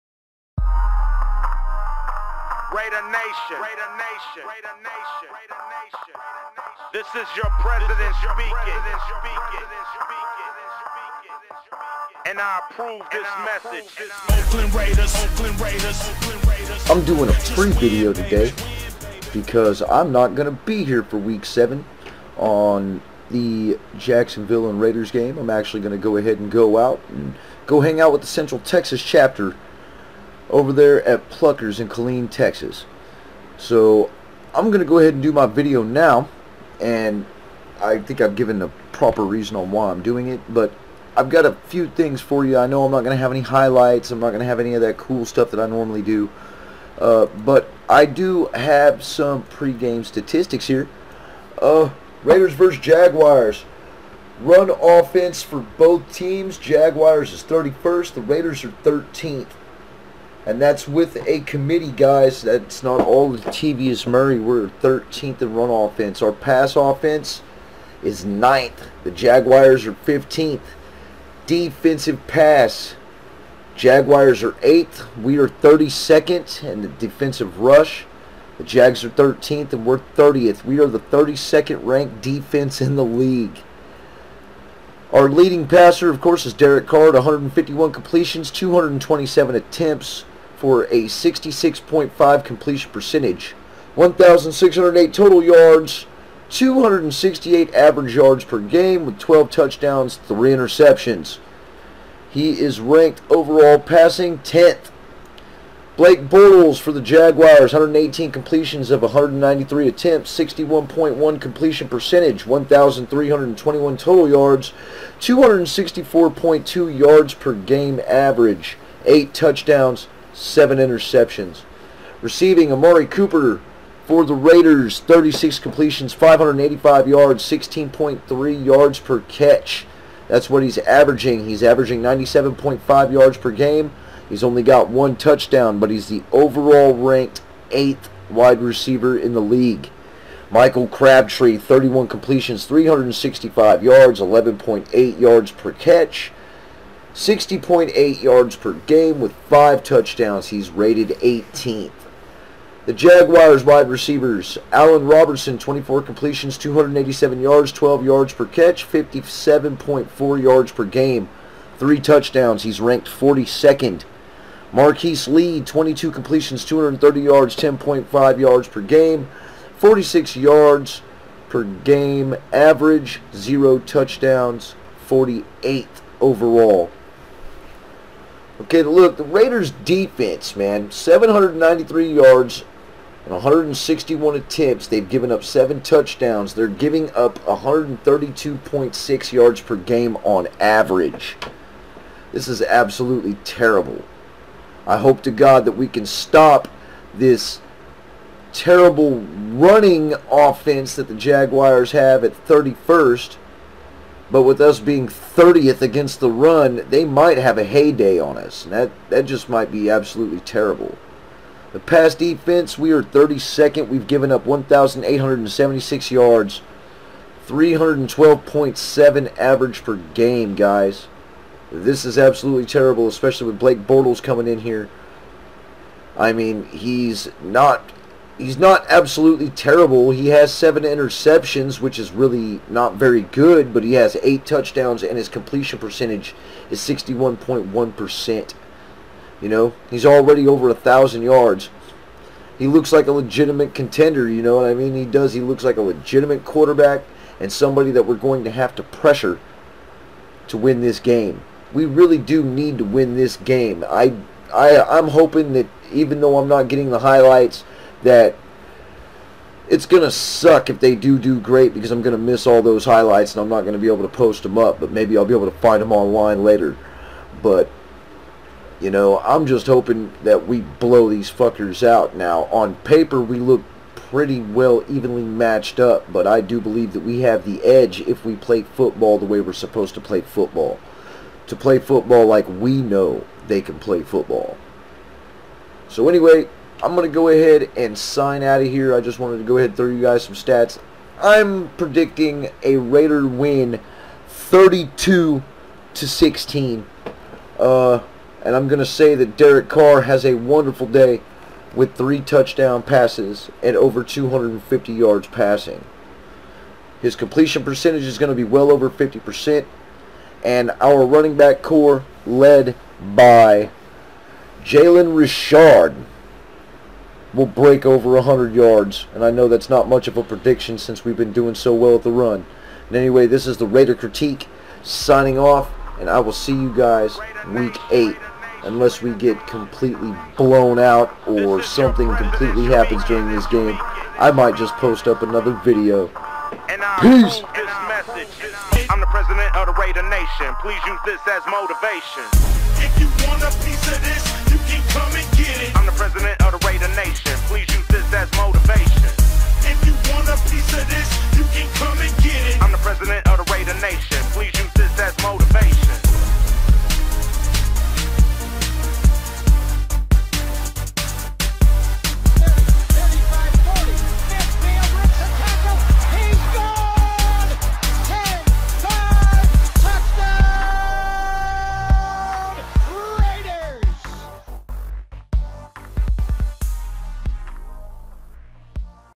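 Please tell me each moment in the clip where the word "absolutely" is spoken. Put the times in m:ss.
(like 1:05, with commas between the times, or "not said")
3:12, 3:29, 3:42, 3:48.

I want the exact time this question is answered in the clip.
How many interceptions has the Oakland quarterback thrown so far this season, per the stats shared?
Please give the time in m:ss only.
1:40.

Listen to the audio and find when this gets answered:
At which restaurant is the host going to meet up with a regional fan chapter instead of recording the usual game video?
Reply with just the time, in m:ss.
0:31.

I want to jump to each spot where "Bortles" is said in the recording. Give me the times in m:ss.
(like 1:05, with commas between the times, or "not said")
1:46, 3:43.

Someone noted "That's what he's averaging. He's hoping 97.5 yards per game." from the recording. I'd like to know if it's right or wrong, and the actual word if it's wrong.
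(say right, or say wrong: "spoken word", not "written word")
wrong: "averaging", not "hoping".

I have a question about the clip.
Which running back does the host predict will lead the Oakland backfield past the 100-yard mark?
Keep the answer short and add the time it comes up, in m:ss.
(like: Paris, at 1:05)
Jalen Richard, at 5:14.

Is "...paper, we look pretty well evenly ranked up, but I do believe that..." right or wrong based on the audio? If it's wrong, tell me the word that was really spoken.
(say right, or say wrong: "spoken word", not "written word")
wrong: "matched", not "ranked".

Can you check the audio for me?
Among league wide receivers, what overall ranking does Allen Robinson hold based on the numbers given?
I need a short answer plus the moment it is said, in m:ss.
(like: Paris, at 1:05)
42nd, at 2:43.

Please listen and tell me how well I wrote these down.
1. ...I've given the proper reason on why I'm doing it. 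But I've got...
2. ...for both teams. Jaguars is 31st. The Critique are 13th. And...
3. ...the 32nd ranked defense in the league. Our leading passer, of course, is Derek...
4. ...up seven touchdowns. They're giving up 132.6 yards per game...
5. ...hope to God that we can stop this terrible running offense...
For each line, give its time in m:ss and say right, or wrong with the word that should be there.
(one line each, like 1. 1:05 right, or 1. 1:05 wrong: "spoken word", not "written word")
1. 0:38 right
2. 0:55 wrong: "Raiders", not "Critique"
3. 1:20 right
4. 3:05 right
5. 3:14 right.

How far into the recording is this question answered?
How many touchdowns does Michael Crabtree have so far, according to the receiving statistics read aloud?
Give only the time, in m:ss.
2:29.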